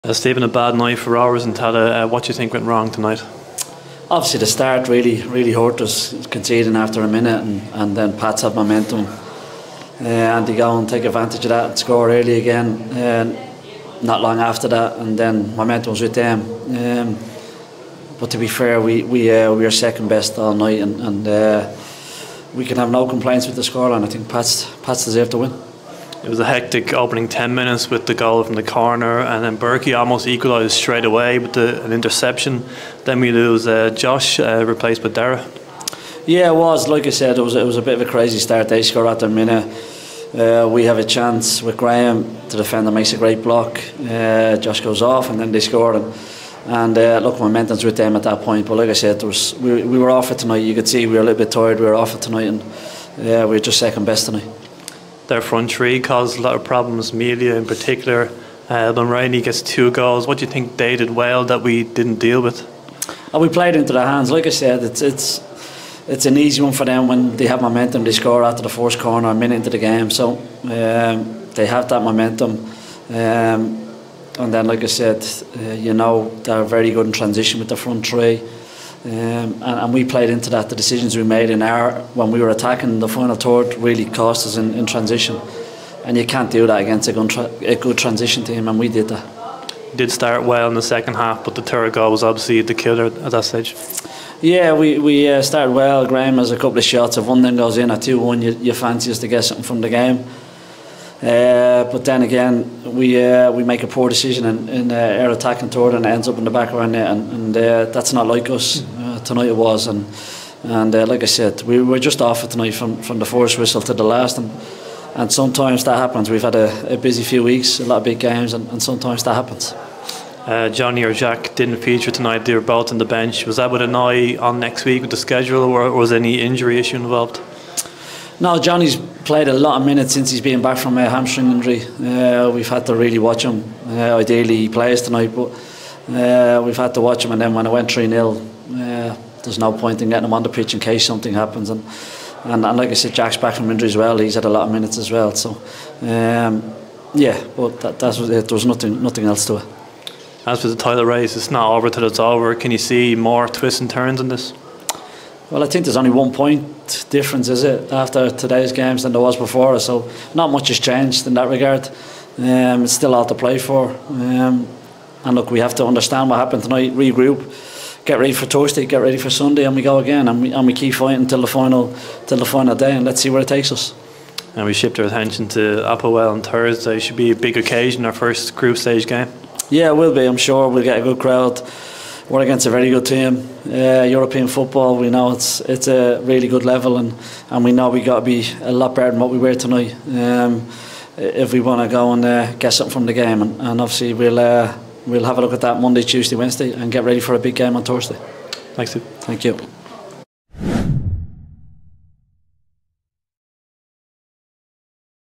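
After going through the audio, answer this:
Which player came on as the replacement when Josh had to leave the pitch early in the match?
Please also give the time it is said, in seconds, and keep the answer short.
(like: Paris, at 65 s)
Dara, at 35 s.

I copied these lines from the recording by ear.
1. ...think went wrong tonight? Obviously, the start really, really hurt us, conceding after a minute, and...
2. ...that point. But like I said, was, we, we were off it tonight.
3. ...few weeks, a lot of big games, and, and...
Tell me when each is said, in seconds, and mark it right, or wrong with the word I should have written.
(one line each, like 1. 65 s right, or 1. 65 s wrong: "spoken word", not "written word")
1. 2 s right
2. 48 s right
3. 117 s right.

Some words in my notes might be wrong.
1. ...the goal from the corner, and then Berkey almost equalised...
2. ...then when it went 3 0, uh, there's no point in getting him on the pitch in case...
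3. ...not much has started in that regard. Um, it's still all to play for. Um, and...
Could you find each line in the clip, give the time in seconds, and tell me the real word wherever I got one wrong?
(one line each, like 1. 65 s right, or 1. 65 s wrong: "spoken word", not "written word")
1. 28 s right
2. 137 s right
3. 160 s wrong: "changed", not "started".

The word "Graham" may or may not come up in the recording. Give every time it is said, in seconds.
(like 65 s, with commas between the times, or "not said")
41 s, 96 s.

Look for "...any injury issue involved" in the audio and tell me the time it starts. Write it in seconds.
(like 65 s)
126 s.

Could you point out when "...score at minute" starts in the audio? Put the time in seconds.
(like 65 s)
38 s.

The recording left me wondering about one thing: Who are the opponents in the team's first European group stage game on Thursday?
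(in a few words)
APOEL.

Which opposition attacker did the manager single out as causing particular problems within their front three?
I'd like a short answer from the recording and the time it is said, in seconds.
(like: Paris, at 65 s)
Melia, at 57 s.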